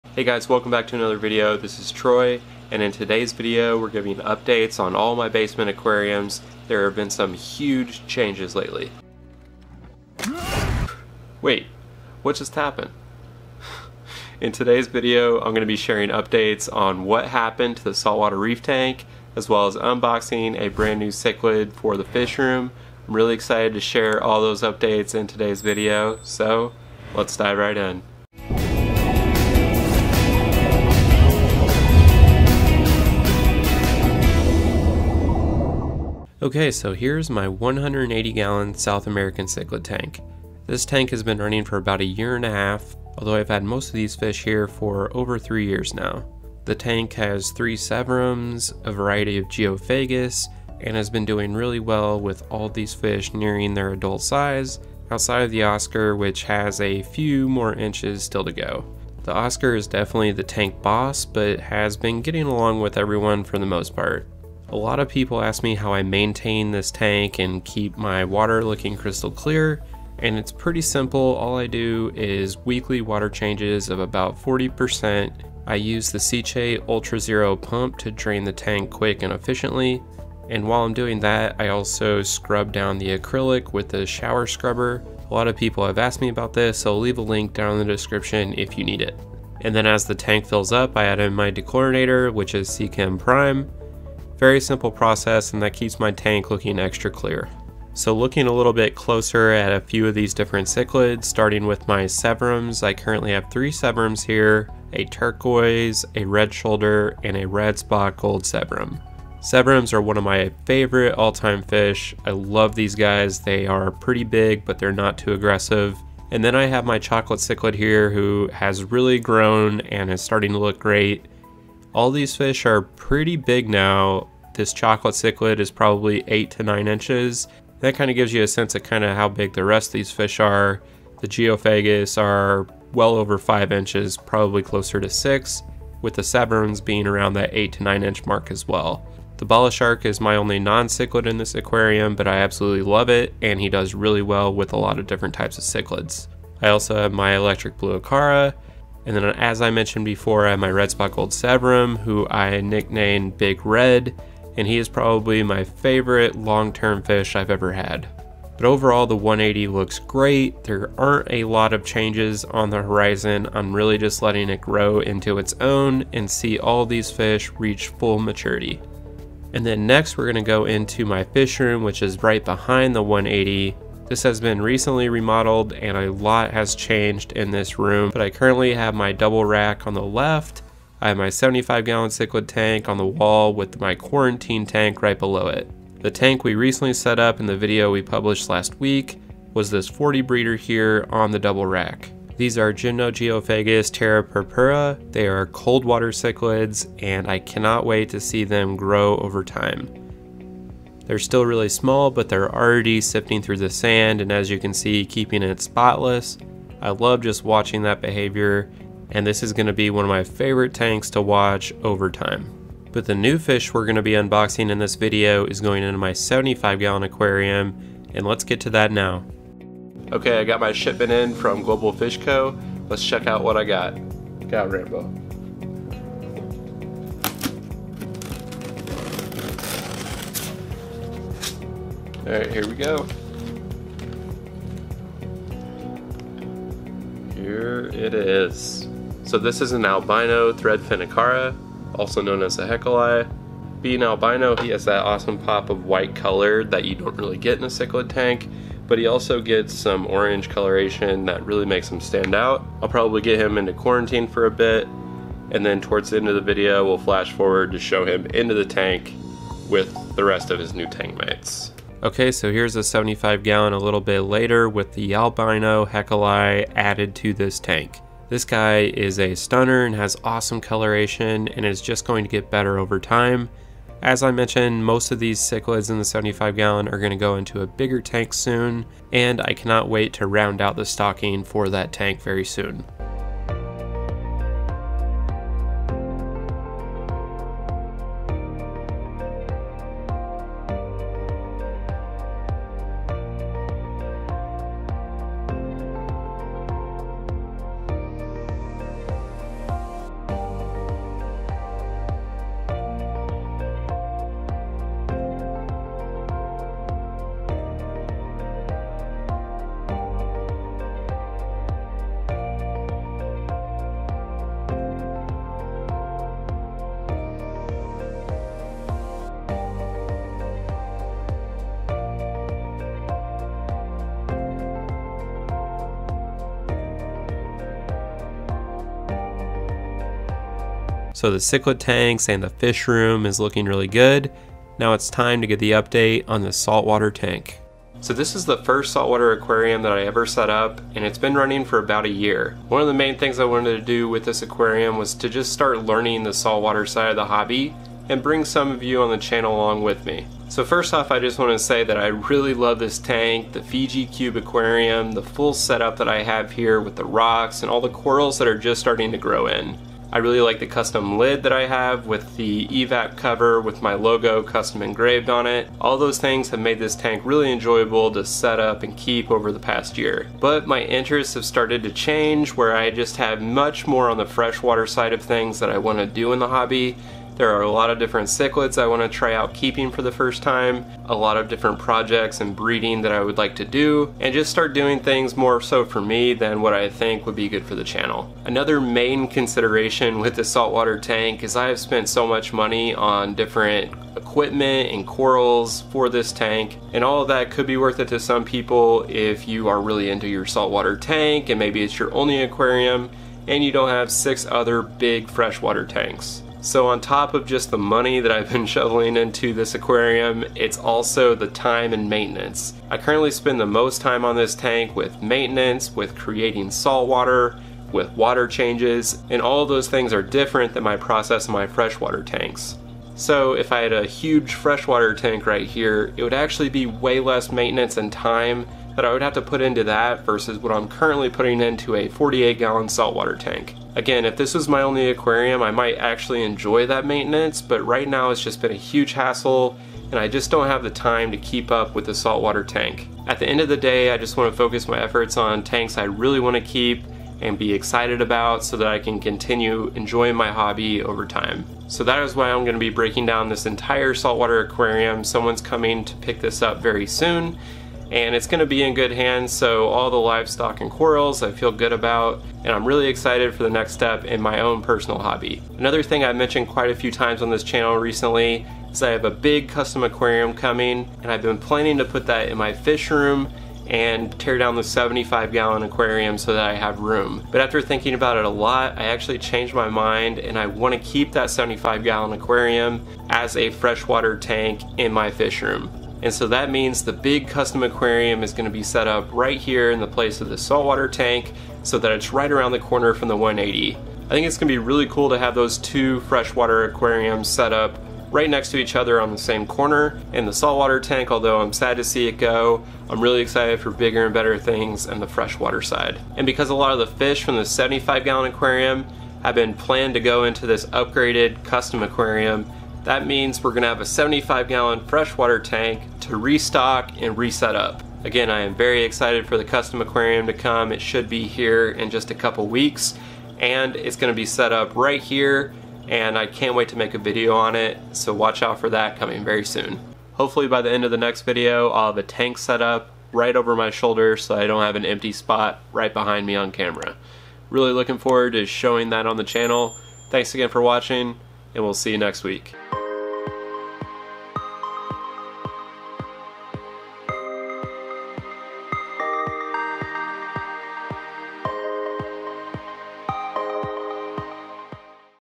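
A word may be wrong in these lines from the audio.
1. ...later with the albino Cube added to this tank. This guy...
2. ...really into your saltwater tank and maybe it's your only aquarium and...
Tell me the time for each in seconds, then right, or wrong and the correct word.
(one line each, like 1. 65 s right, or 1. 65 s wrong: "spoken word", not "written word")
1. 264 s wrong: "Heckeli", not "Cube"
2. 399 s right.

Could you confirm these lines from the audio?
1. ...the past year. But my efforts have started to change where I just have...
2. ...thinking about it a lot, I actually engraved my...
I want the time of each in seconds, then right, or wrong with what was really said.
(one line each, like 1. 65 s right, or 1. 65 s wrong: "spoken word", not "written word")
1. 369 s wrong: "interests", not "efforts"
2. 477 s wrong: "changed", not "engraved".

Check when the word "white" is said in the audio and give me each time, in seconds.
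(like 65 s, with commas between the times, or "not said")
245 s.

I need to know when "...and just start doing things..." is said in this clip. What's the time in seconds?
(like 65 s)
384 s.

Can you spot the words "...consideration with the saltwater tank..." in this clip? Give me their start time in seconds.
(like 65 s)
389 s.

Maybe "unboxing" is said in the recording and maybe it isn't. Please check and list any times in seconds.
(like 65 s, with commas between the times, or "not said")
19 s, 214 s.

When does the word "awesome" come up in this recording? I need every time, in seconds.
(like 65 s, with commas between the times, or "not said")
245 s, 270 s.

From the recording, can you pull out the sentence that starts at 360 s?
I really like the custom lid that I have with the EVAP cover with my logo custom engraved on it.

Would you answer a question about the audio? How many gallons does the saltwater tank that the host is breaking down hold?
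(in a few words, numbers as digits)
48.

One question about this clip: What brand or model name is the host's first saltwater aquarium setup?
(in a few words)
Fiji Cube.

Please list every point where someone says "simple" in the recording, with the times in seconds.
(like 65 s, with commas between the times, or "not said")
70 s, 94 s.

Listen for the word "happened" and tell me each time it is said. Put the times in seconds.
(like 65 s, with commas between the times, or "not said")
12 s, 17 s.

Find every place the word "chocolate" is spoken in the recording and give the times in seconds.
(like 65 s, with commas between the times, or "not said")
116 s, 124 s.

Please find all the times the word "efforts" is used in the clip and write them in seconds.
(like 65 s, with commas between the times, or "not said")
445 s.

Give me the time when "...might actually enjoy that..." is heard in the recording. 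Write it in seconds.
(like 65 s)
435 s.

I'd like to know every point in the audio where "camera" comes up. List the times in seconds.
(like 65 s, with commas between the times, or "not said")
536 s.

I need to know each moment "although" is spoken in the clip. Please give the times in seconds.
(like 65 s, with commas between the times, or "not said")
43 s, 501 s.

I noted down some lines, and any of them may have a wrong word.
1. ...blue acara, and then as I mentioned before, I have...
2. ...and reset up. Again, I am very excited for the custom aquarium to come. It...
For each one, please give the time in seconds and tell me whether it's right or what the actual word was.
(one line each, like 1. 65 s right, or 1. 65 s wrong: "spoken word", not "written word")
1. 147 s right
2. 517 s right.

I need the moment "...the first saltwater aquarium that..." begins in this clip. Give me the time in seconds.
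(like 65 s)
338 s.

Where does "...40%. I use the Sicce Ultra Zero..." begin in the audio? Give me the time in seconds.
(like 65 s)
74 s.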